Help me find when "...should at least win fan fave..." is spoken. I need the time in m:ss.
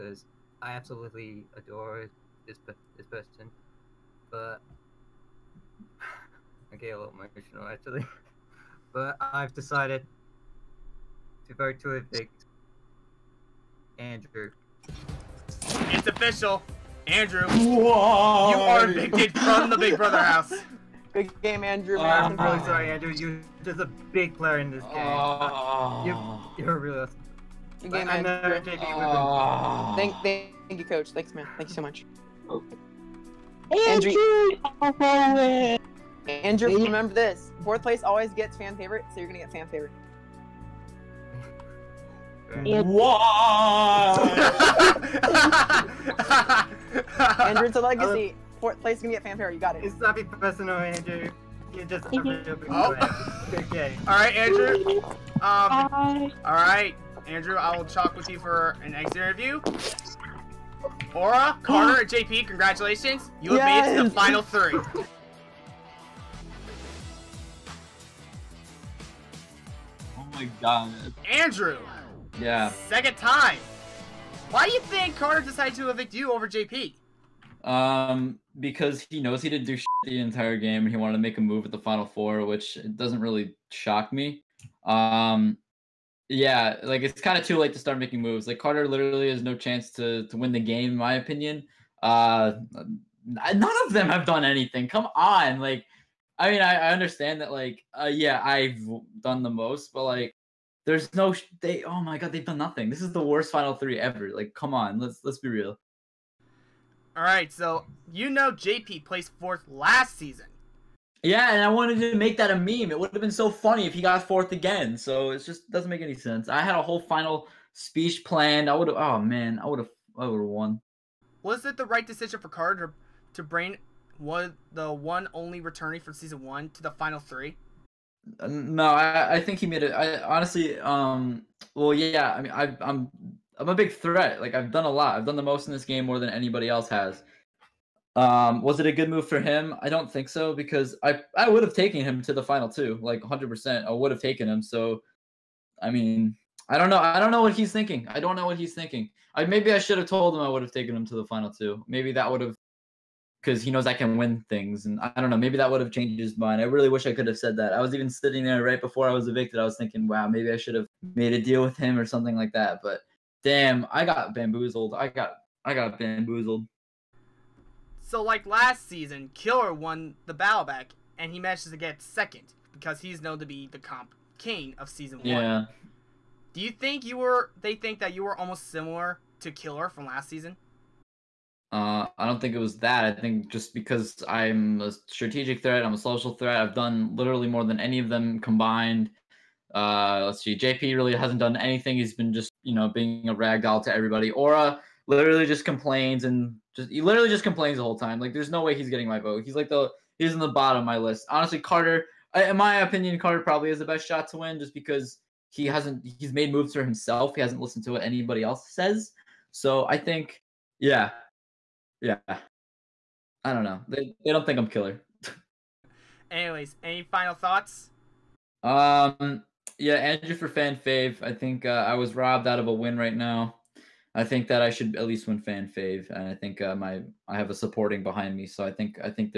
3:44.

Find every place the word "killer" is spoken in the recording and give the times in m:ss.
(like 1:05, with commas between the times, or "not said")
2:49, 2:59, 3:34.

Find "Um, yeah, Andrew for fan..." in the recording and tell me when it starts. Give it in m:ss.
3:38.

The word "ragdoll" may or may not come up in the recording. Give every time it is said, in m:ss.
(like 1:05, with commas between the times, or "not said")
3:13.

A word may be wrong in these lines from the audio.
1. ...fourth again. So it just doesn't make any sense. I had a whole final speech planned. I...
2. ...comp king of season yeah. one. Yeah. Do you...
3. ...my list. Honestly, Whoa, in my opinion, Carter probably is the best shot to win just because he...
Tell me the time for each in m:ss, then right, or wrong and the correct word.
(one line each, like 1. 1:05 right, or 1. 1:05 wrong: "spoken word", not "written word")
1. 1:54 right
2. 2:53 right
3. 3:20 wrong: "Carter", not "Whoa".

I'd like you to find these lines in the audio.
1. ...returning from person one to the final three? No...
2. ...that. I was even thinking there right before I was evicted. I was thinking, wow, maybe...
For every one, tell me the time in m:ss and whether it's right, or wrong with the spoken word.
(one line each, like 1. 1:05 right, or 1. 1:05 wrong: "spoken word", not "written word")
1. 2:05 wrong: "season", not "person"
2. 2:37 wrong: "sitting", not "thinking".